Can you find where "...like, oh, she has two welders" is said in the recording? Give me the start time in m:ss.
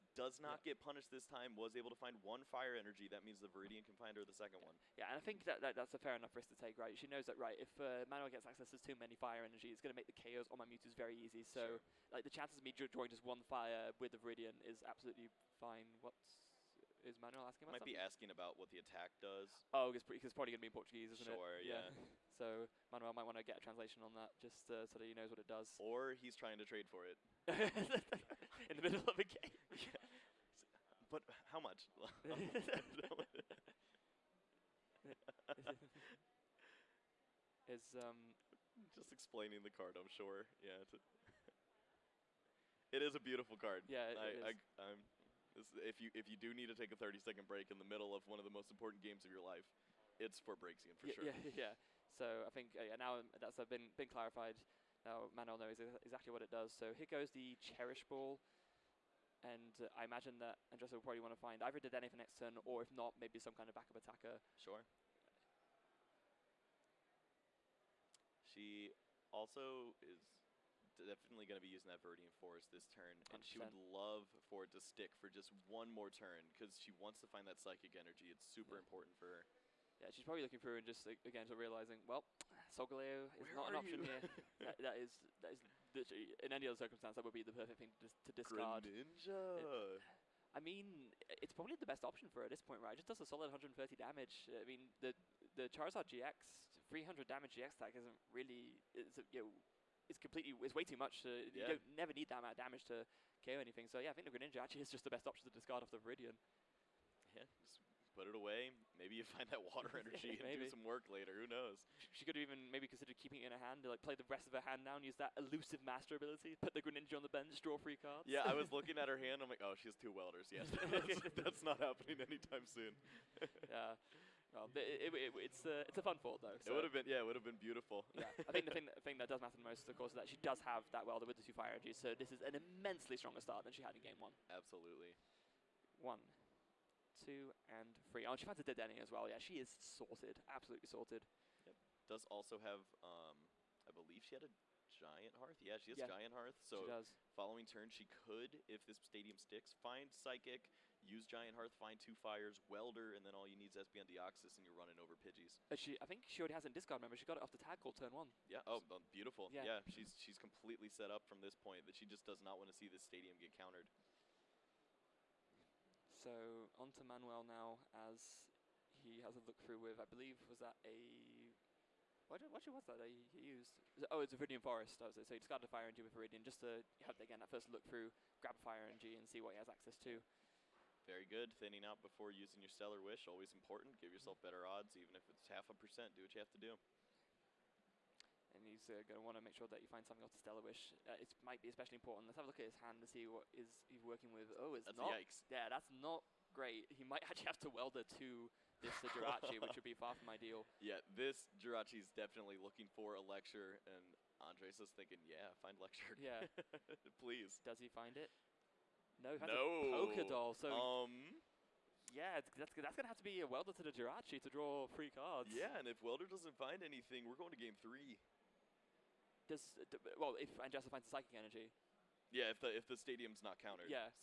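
1:59.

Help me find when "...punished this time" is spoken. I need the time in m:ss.
0:00.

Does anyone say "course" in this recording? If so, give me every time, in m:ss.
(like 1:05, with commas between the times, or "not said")
2:09.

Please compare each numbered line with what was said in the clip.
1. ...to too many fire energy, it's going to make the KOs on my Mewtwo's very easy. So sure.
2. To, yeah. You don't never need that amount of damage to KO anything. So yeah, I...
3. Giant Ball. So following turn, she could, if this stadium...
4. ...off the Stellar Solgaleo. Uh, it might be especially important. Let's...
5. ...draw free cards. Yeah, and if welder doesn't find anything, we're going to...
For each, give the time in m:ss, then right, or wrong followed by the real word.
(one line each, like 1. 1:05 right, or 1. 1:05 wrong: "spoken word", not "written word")
1. 0:08 right
2. 1:41 right
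3. 2:26 wrong: "Hearth", not "Ball"
4. 3:10 wrong: "Wish", not "Solgaleo"
5. 3:34 right.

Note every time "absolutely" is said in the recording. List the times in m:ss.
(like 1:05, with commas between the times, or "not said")
0:14, 2:14, 2:20.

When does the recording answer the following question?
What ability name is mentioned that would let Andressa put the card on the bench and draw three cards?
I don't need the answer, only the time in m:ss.
1:55.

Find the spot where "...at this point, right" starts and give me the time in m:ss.
1:32.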